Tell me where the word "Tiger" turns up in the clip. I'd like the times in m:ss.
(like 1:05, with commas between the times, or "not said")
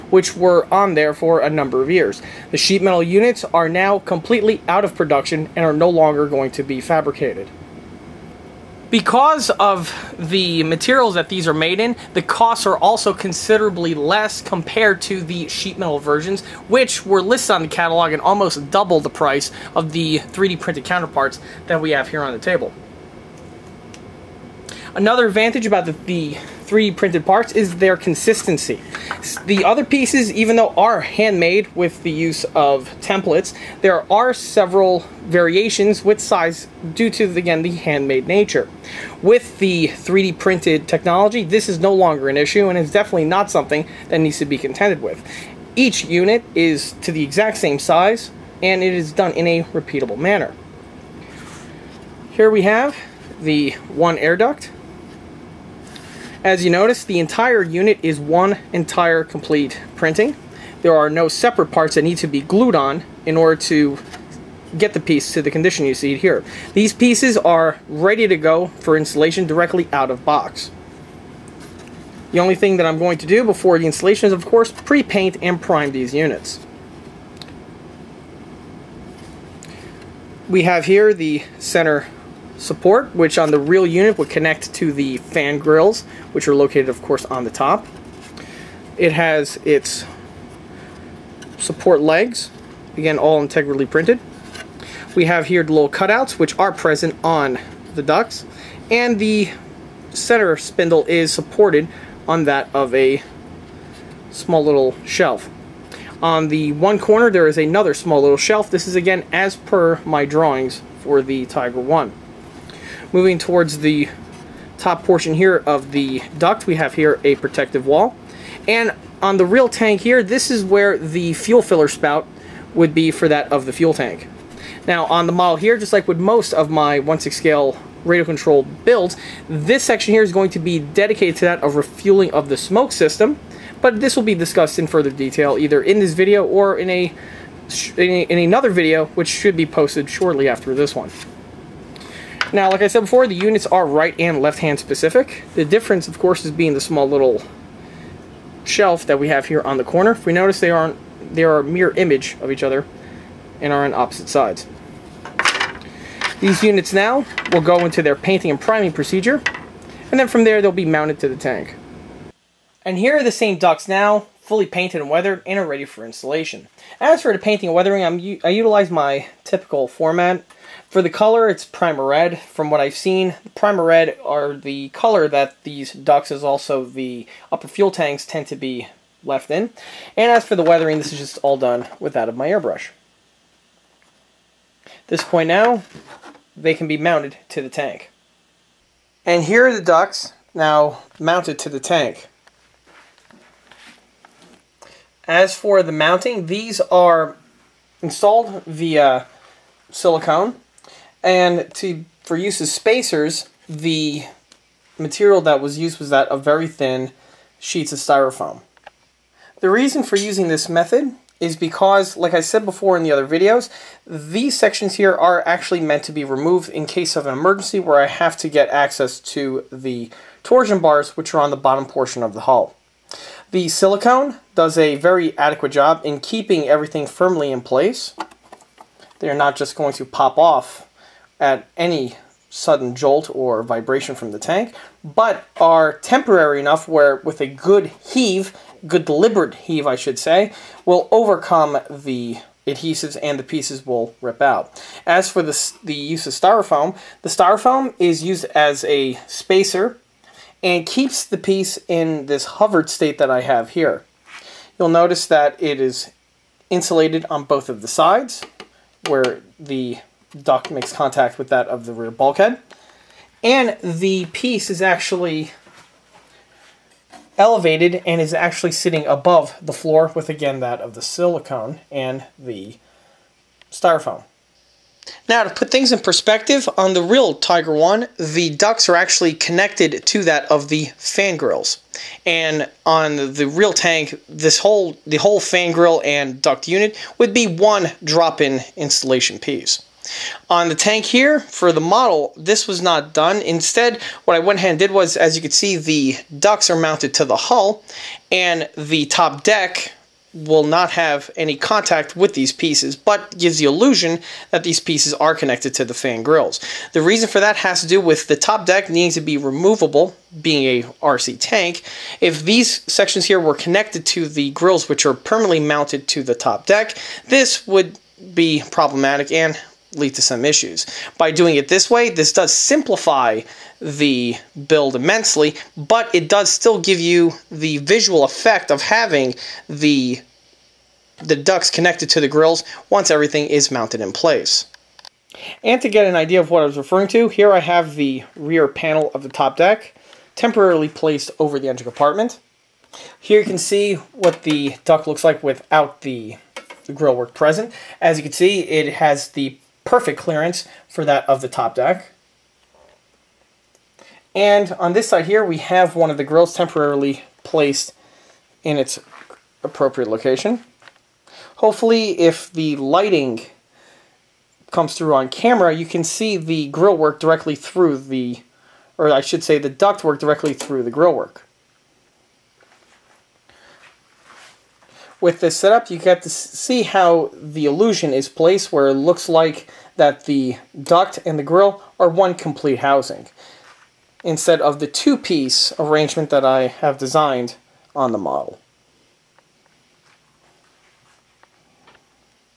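1:51, 4:37.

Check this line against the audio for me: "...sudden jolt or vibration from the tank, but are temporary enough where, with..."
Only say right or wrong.
right.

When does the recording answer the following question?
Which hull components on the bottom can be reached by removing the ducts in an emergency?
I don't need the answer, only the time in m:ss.
3:40.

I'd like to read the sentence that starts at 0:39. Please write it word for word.
With the 3D printed technology, this is no longer an issue and is definitely not something that needs to be contended with.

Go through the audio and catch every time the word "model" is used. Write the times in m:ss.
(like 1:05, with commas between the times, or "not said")
2:05, 4:51, 6:28.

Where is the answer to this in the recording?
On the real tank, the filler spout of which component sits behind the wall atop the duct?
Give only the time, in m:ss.
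2:03.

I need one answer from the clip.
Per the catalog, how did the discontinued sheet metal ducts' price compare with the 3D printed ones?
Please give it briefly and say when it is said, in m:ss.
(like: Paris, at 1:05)
almost double, at 0:18.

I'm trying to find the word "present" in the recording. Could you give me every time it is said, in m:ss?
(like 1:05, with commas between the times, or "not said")
1:36, 5:47.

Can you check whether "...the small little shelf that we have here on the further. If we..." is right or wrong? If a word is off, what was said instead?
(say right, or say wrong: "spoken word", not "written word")
wrong: "corner", not "further".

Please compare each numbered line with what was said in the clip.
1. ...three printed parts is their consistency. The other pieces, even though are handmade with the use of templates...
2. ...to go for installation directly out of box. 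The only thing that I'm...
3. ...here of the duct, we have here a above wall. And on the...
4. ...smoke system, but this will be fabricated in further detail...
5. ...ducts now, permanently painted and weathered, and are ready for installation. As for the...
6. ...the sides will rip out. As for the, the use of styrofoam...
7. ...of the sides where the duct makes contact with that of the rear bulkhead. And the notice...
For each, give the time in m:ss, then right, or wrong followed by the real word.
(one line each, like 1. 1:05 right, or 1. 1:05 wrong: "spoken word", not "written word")
1. 0:26 right
2. 1:08 right
3. 1:55 wrong: "protective", not "above"
4. 2:12 wrong: "discussed", not "fabricated"
5. 2:43 wrong: "fully", not "permanently"
6. 4:03 wrong: "pieces", not "sides"
7. 4:17 wrong: "piece", not "notice".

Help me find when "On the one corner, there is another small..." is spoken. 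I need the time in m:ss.
1:46.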